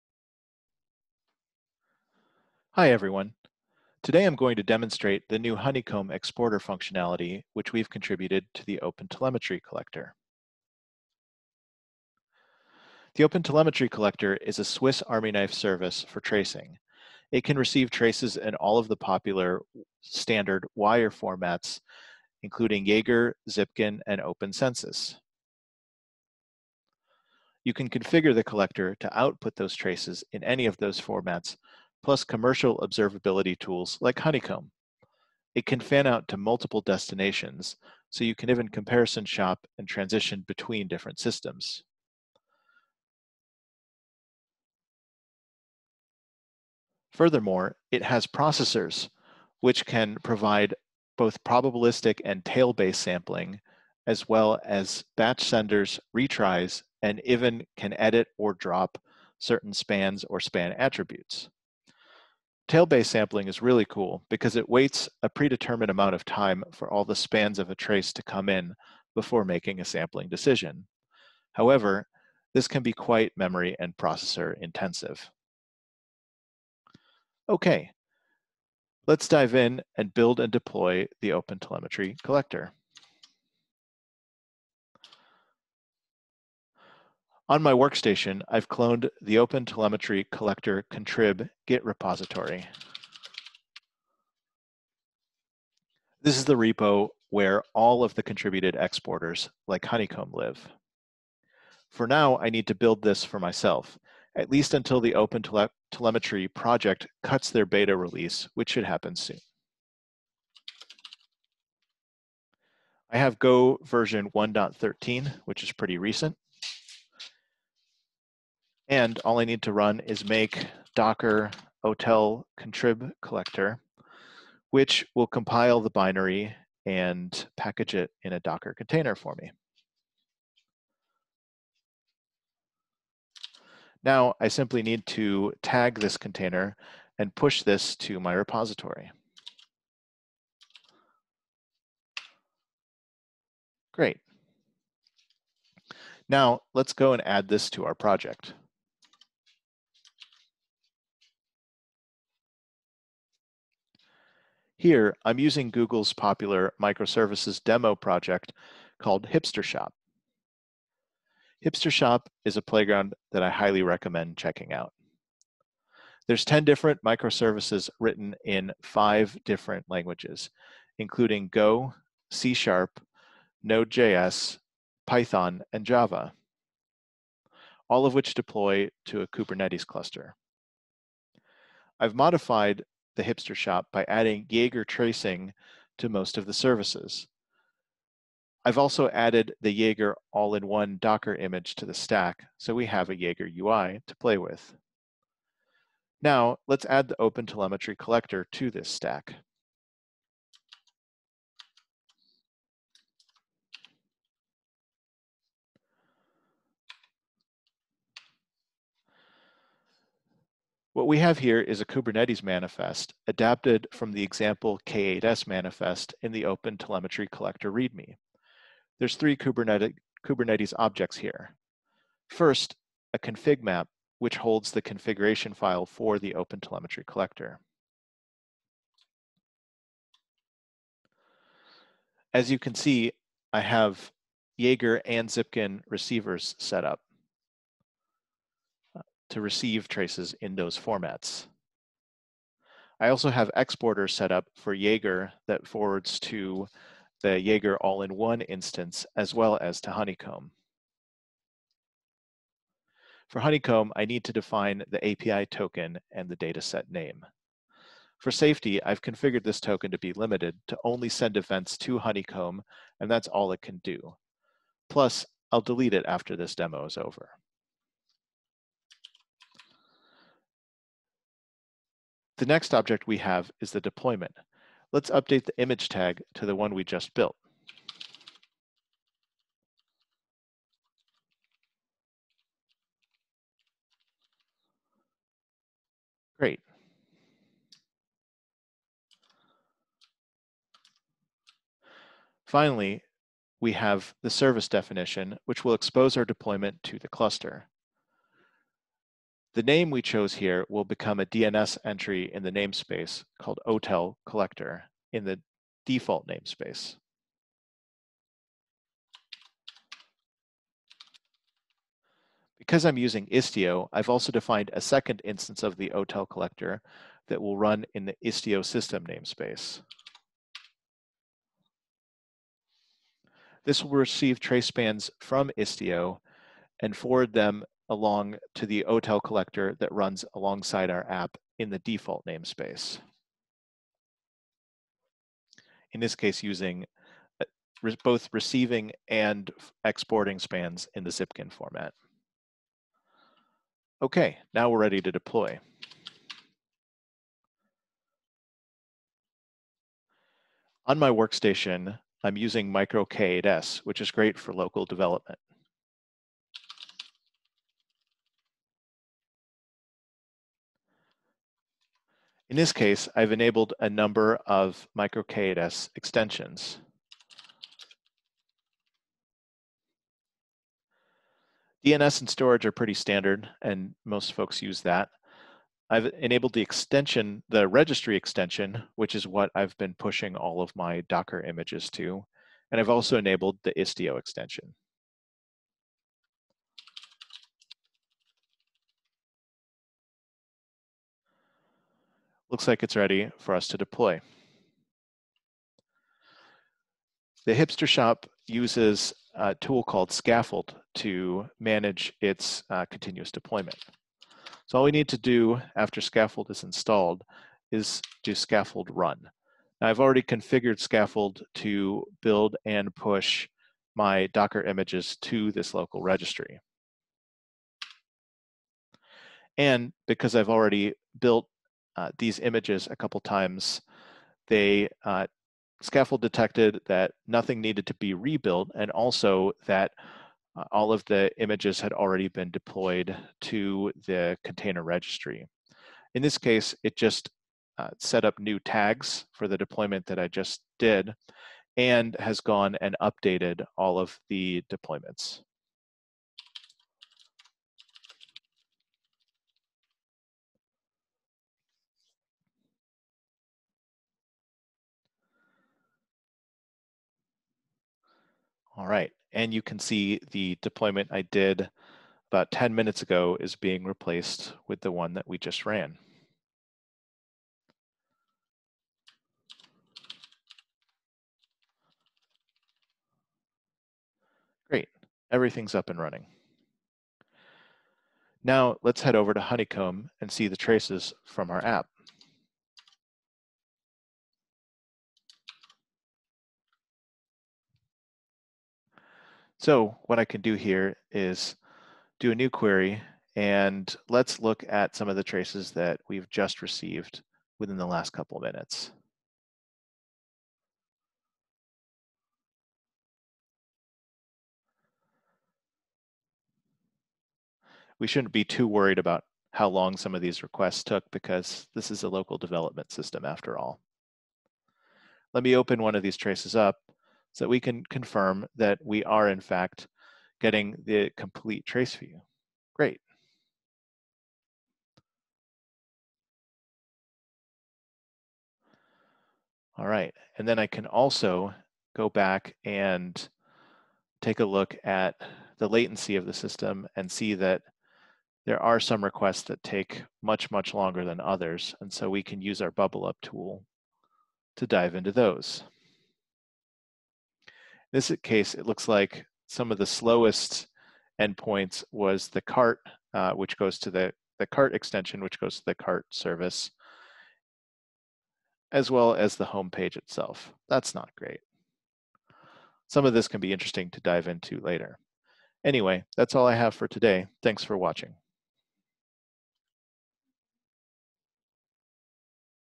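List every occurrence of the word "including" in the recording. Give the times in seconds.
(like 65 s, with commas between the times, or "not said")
22 s, 170 s.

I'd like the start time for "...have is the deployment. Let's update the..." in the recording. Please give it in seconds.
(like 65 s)
273 s.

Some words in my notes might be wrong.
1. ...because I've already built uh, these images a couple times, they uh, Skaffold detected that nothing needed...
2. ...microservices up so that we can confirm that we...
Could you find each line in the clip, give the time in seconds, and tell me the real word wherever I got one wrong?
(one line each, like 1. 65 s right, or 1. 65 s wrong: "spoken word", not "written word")
1. 420 s right
2. 516 s wrong: "traces", not "microservices".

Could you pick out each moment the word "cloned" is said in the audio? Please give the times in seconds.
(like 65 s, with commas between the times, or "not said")
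88 s.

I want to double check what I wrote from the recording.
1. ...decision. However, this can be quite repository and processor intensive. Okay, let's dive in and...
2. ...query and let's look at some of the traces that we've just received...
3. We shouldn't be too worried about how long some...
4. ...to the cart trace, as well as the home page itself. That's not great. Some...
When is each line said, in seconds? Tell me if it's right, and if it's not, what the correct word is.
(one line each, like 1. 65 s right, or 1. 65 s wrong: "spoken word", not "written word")
1. 70 s wrong: "memory", not "repository"
2. 492 s right
3. 507 s right
4. 555 s wrong: "service", not "trace".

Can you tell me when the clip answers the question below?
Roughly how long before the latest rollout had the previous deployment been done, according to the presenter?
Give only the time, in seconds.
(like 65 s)
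462 s.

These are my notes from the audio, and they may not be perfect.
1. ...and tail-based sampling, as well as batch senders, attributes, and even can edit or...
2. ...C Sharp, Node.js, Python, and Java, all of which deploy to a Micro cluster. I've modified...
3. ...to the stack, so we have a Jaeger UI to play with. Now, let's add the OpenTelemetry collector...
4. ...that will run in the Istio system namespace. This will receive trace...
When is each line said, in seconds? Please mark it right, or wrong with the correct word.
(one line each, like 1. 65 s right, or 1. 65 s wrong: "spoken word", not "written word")
1. 52 s wrong: "retries", not "attributes"
2. 172 s wrong: "Kubernetes", not "Micro"
3. 191 s right
4. 317 s right.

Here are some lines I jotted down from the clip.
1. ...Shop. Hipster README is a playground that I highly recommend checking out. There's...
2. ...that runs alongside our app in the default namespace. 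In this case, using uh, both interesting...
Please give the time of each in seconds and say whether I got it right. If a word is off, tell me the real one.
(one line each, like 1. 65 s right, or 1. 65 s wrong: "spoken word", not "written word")
1. 159 s wrong: "Shop", not "README"
2. 329 s wrong: "receiving", not "interesting".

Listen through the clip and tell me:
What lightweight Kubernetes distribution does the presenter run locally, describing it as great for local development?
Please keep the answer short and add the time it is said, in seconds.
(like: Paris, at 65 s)
MicroK8S, at 352 s.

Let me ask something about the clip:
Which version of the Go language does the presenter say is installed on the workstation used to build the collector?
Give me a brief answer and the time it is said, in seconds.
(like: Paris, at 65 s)
1.13, at 114 s.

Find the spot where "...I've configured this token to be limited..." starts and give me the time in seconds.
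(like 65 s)
258 s.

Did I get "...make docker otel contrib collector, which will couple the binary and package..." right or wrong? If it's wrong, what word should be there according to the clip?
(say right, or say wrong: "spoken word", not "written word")
wrong: "compile", not "couple".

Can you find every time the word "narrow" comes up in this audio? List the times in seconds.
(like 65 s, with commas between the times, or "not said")
not said.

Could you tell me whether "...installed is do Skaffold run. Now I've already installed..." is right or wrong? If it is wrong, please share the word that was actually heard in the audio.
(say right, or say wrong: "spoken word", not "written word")
wrong: "configured", not "installed".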